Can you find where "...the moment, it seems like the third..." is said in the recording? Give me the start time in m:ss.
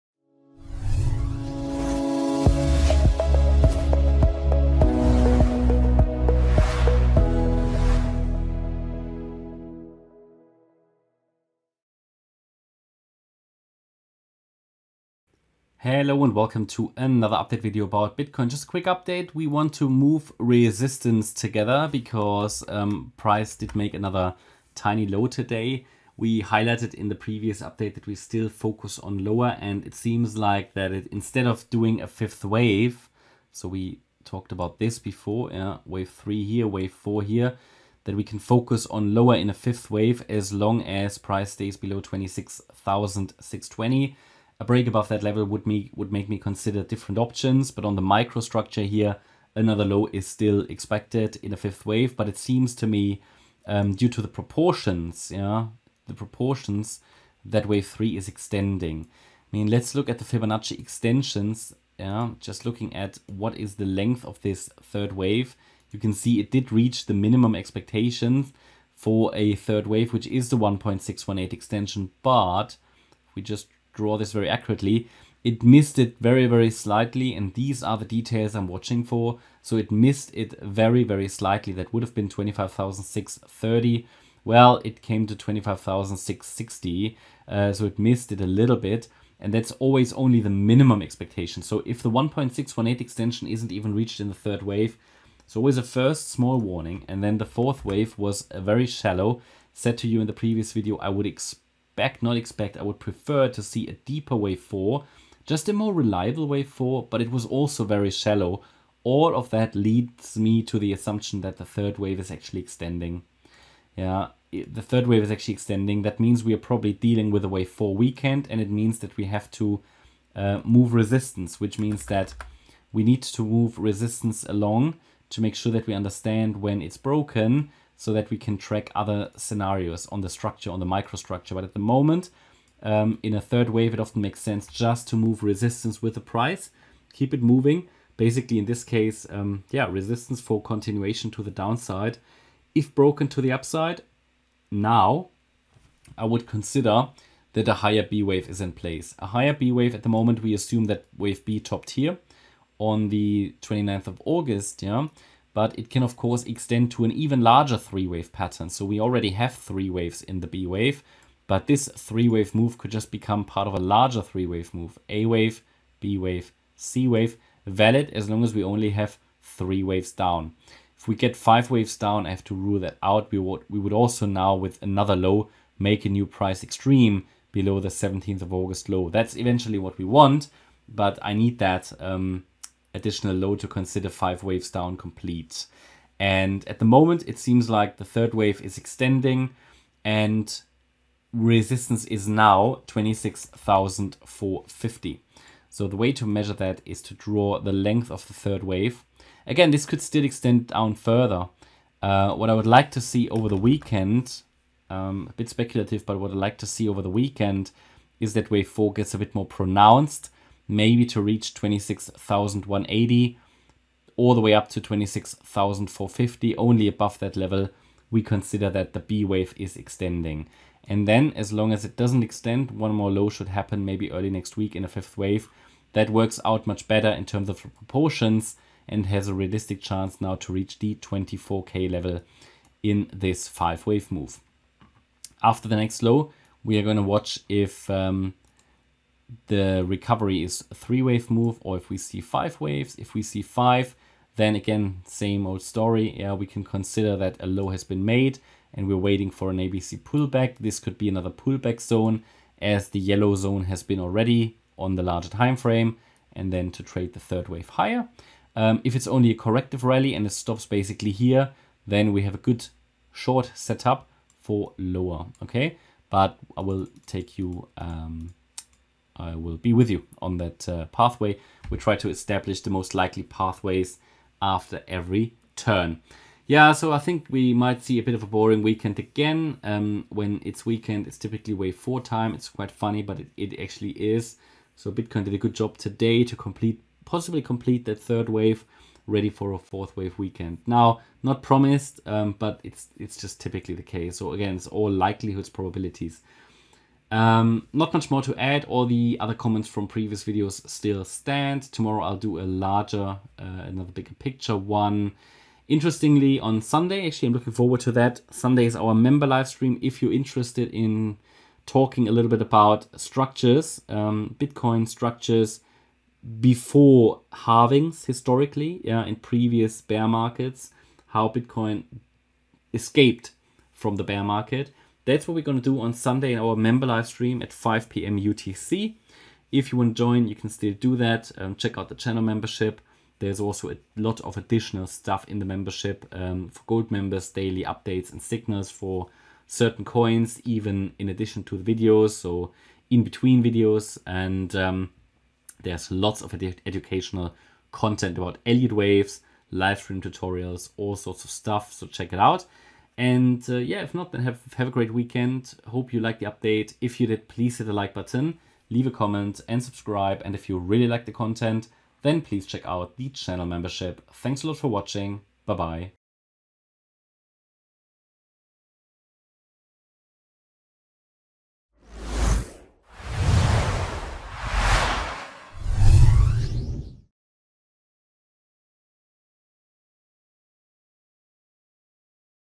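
3:06.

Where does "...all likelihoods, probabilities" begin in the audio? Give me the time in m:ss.
4:54.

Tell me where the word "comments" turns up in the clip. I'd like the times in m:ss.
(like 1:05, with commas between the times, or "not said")
4:59, 5:58.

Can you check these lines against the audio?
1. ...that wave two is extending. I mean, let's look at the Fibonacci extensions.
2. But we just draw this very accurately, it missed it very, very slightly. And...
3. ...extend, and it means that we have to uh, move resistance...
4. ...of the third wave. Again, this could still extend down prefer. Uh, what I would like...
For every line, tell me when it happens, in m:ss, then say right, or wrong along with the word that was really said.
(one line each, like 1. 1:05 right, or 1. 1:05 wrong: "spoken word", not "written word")
1. 0:57 wrong: "three", not "two"
2. 1:12 right
3. 1:57 wrong: "weekend", not "extend"
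4. 3:18 wrong: "further", not "prefer".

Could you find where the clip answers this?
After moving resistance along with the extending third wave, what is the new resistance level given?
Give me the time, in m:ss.
3:12.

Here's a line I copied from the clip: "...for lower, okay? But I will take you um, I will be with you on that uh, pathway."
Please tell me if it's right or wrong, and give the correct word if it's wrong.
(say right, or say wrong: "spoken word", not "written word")
right.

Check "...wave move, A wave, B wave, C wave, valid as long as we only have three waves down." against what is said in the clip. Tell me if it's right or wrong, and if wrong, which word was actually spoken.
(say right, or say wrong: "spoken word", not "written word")
right.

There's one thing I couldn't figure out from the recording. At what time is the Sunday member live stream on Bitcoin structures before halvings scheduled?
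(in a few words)
5 p.m. UTC.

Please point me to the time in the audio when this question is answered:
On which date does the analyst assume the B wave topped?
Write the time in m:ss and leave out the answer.
2:33.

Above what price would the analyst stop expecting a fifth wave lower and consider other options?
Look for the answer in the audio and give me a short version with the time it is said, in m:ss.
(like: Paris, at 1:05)
26,620, at 0:42.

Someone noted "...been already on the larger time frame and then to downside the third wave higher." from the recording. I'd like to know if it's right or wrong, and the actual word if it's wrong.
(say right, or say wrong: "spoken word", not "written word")
wrong: "trade", not "downside".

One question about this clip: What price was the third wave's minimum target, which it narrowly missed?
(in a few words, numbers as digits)
25,630.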